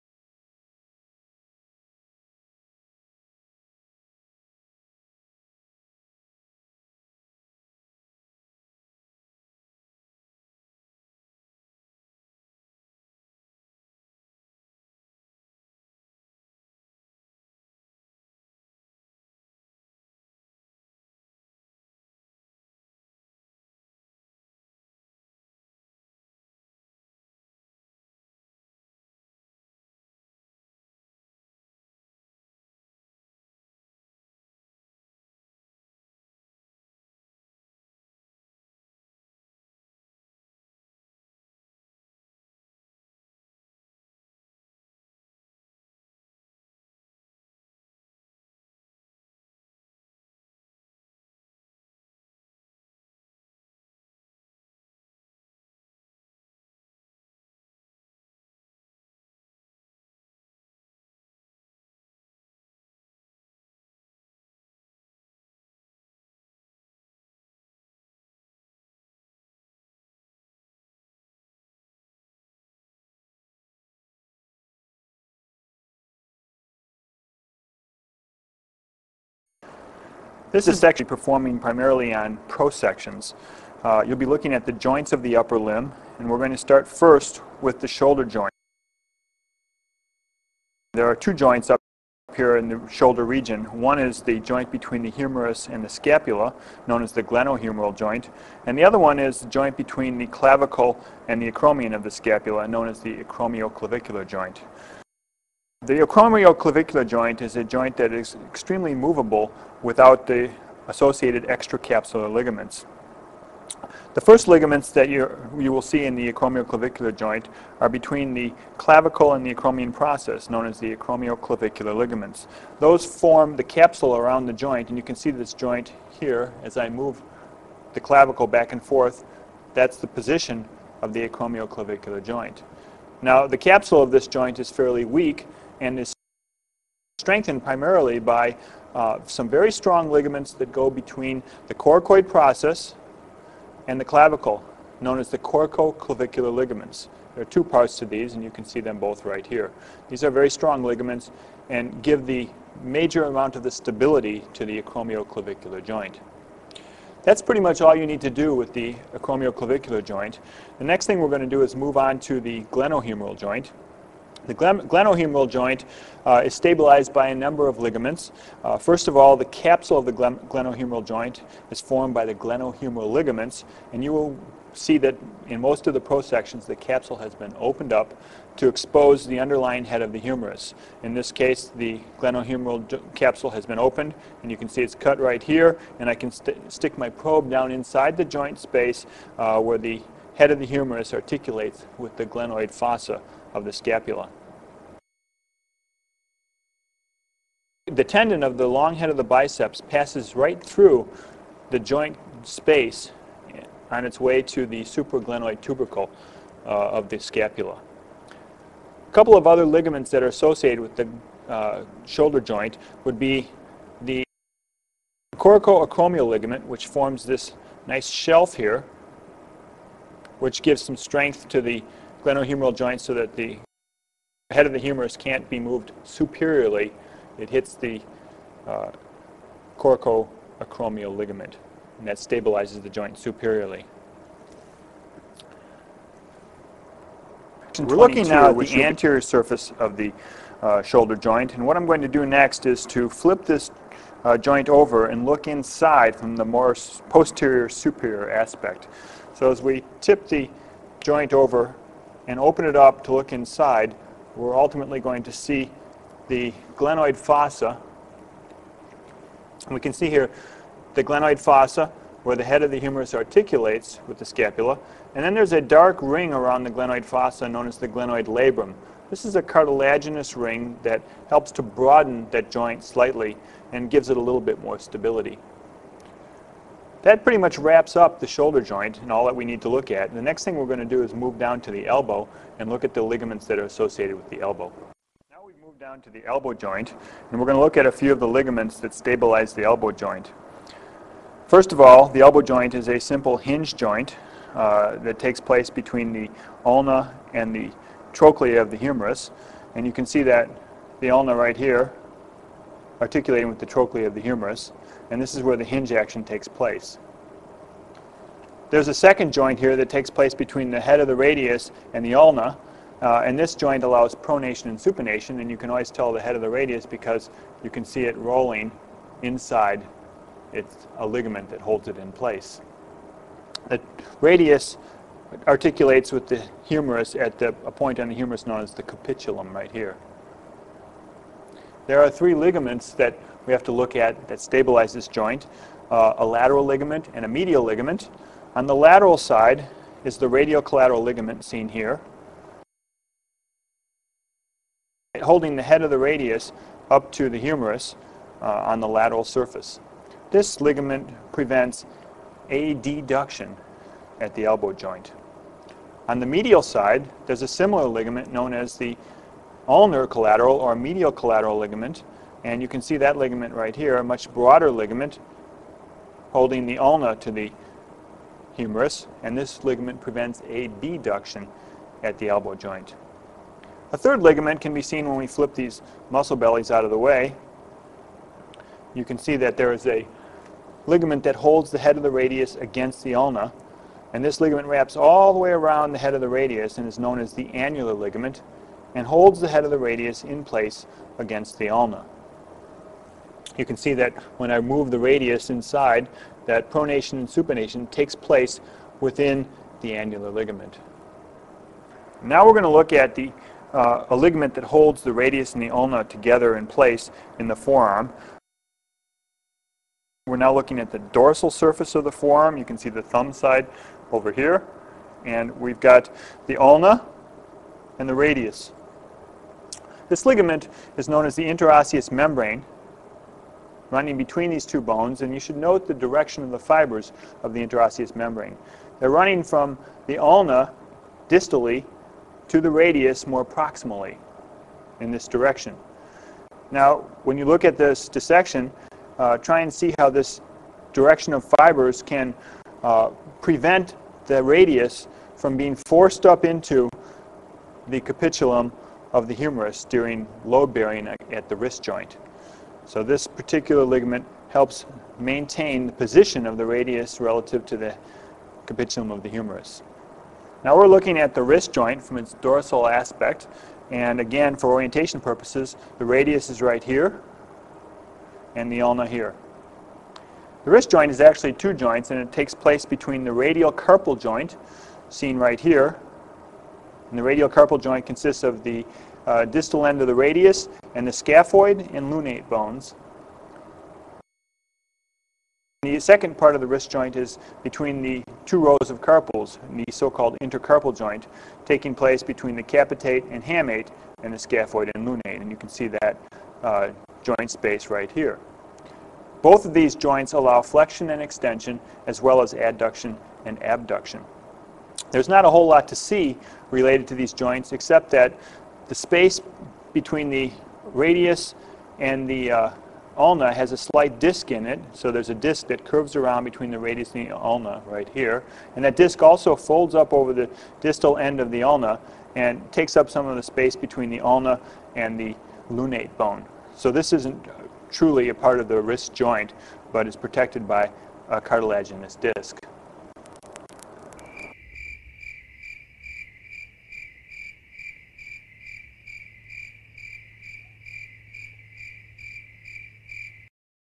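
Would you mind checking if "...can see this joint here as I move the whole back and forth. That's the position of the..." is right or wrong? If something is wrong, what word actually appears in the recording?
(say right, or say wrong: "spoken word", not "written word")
wrong: "clavicle", not "whole".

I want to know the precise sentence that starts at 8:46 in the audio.
So this isn't truly a part of the wrist joint, but is protected by a cartilaginous disc.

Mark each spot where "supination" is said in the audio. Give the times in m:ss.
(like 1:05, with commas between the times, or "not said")
5:14, 6:37.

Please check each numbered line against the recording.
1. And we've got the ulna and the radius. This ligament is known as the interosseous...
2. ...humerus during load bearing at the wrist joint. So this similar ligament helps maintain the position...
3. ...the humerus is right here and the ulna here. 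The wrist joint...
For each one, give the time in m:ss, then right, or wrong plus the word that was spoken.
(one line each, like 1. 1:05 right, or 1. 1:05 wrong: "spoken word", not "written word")
1. 6:55 right
2. 7:29 wrong: "particular", not "similar"
3. 7:45 wrong: "radius", not "humerus".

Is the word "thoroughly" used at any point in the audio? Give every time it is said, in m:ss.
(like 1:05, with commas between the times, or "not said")
not said.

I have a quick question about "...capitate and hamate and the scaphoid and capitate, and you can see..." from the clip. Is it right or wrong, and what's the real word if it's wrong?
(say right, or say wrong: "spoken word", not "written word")
wrong: "lunate", not "capitate".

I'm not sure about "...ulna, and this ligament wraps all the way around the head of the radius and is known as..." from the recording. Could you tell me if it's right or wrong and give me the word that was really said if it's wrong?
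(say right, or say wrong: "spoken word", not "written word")
right.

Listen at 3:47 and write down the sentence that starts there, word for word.
It hits the uh, coracoacromial ligament, and that stabilizes the joint superiorly.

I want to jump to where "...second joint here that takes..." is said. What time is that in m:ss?
5:08.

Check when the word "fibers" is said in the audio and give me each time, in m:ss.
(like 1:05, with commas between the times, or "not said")
7:06, 7:21.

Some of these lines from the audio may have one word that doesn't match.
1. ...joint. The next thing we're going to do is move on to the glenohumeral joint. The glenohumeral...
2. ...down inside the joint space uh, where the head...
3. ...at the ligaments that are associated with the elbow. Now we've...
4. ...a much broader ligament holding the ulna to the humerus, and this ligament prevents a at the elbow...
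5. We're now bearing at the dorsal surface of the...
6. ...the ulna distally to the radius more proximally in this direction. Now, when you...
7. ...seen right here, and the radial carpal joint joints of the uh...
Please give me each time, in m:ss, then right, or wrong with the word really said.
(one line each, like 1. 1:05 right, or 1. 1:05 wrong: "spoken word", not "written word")
1. 2:40 right
2. 3:07 right
3. 4:42 right
4. 6:03 right
5. 6:50 wrong: "looking", not "bearing"
6. 7:10 right
7. 7:55 wrong: "consists", not "joints".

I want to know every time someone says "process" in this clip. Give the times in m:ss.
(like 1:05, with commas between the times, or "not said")
1:59, 2:22.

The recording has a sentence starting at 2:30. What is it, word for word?
These are very strong ligaments and give the major amount of the stability to the acromioclavicular joint.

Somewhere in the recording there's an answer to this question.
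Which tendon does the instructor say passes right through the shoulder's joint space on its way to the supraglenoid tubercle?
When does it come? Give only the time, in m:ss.
3:18.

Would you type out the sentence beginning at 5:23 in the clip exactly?
The radius articulates with the humerus at the, a point on the humerus known as the capitulum right here.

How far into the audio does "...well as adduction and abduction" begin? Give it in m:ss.
8:22.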